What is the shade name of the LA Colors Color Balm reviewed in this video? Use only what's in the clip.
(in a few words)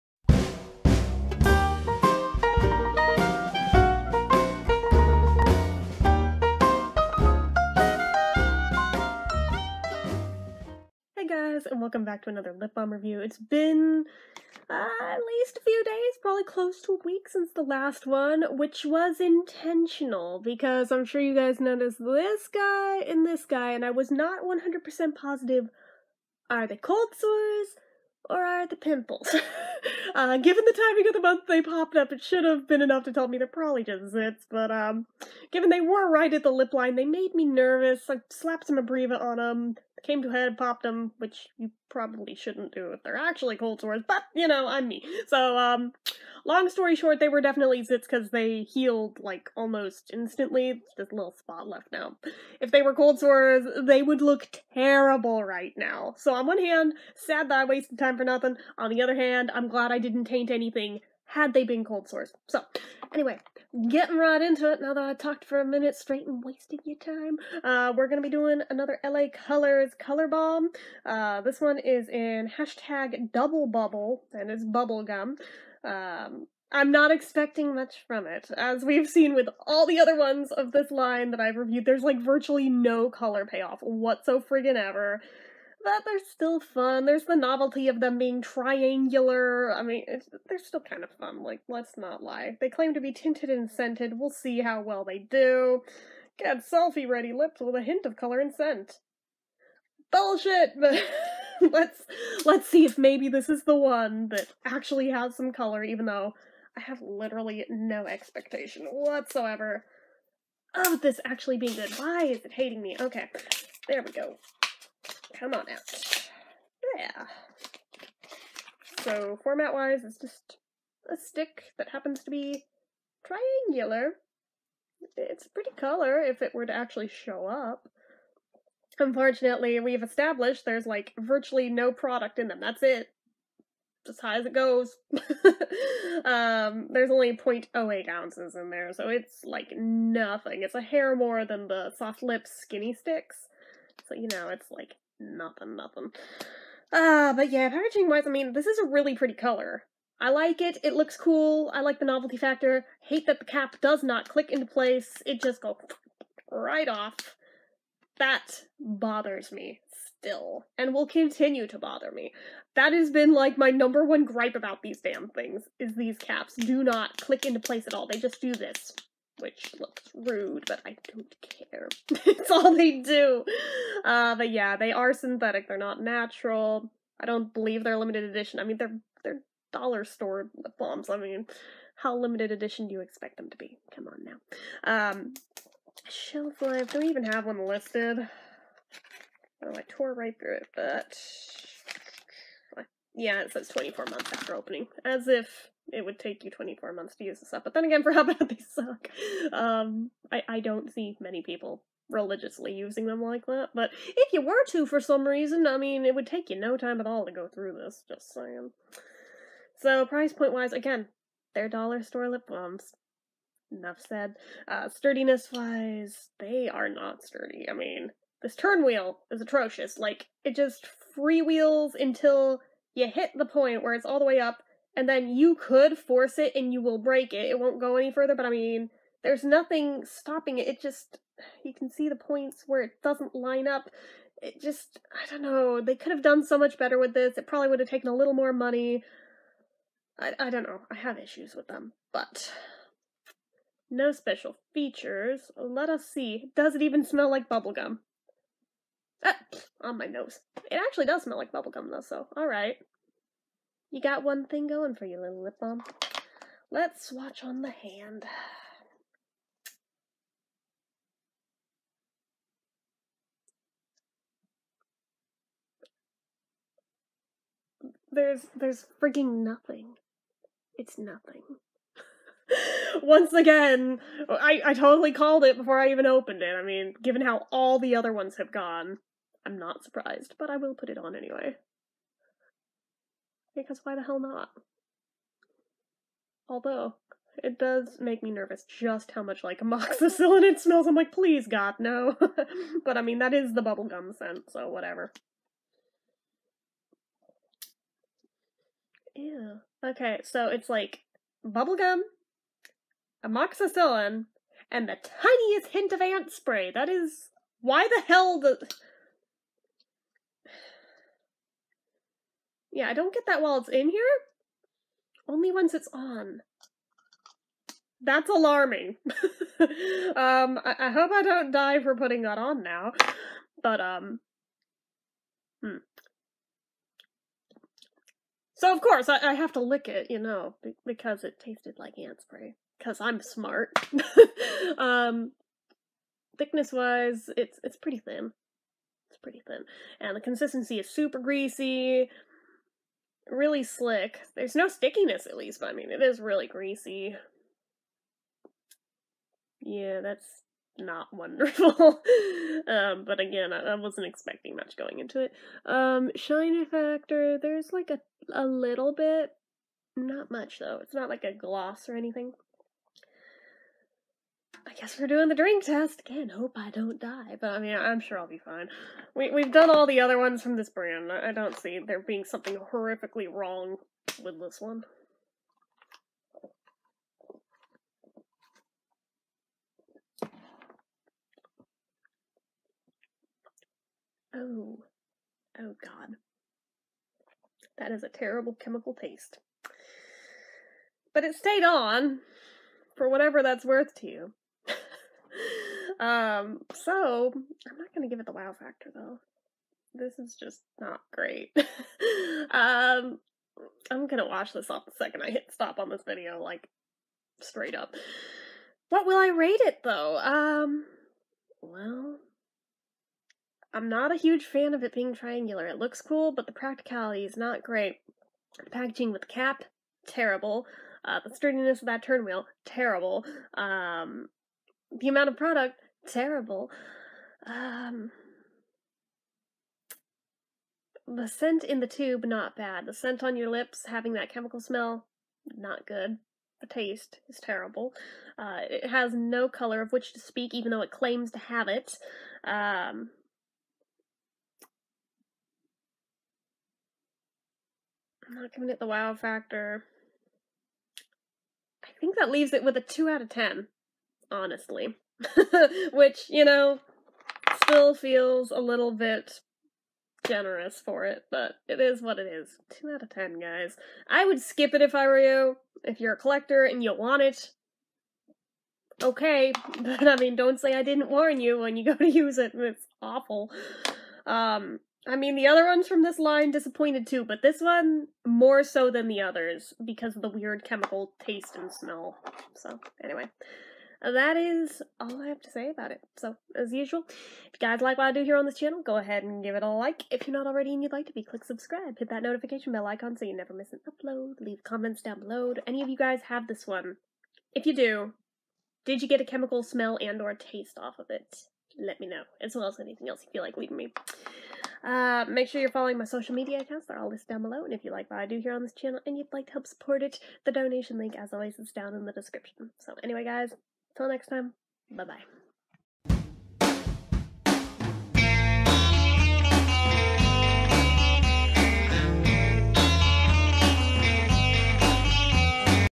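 Double Bubble.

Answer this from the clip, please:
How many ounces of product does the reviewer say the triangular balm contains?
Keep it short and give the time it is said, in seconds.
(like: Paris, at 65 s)
0.08, at 137 s.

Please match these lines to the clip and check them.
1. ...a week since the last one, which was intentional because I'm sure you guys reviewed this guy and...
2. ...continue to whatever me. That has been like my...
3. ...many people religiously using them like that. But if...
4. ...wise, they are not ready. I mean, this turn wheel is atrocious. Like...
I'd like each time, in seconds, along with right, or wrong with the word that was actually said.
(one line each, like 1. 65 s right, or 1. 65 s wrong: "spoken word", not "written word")
1. 16 s wrong: "noticed", not "reviewed"
2. 161 s wrong: "bother", not "whatever"
3. 201 s right
4. 215 s wrong: "sturdy", not "ready".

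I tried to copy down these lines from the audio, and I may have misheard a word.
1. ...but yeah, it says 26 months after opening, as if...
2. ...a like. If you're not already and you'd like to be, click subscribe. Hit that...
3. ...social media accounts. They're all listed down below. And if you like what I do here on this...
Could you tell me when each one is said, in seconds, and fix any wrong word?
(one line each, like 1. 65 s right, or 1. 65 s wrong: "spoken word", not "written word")
1. 190 s wrong: "24", not "26"
2. 489 s right
3. 506 s right.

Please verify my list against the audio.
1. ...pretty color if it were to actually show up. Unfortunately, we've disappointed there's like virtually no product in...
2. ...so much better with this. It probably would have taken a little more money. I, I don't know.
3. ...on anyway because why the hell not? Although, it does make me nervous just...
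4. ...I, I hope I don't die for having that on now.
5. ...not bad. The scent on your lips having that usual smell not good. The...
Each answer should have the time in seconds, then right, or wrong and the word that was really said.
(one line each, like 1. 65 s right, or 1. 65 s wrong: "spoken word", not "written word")
1. 125 s wrong: "established", not "disappointed"
2. 236 s right
3. 280 s right
4. 320 s wrong: "putting", not "having"
5. 432 s wrong: "chemical", not "usual".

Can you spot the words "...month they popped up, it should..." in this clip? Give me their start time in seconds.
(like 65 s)
31 s.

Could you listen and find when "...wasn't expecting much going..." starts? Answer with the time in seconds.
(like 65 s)
353 s.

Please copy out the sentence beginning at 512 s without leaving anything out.
So anyway, guys, Till next time, bye bye.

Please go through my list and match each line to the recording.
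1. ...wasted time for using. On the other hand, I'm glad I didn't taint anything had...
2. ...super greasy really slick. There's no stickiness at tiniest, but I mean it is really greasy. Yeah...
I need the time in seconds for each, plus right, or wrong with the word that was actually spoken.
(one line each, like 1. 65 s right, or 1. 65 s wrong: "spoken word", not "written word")
1. 57 s wrong: "nothing", not "using"
2. 340 s wrong: "least", not "tiniest".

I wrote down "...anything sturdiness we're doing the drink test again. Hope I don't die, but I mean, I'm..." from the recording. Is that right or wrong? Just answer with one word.
wrong.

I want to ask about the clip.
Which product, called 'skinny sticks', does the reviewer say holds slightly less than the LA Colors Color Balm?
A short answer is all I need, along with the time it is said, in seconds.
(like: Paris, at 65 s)
soft lip skinny sticks, at 141 s.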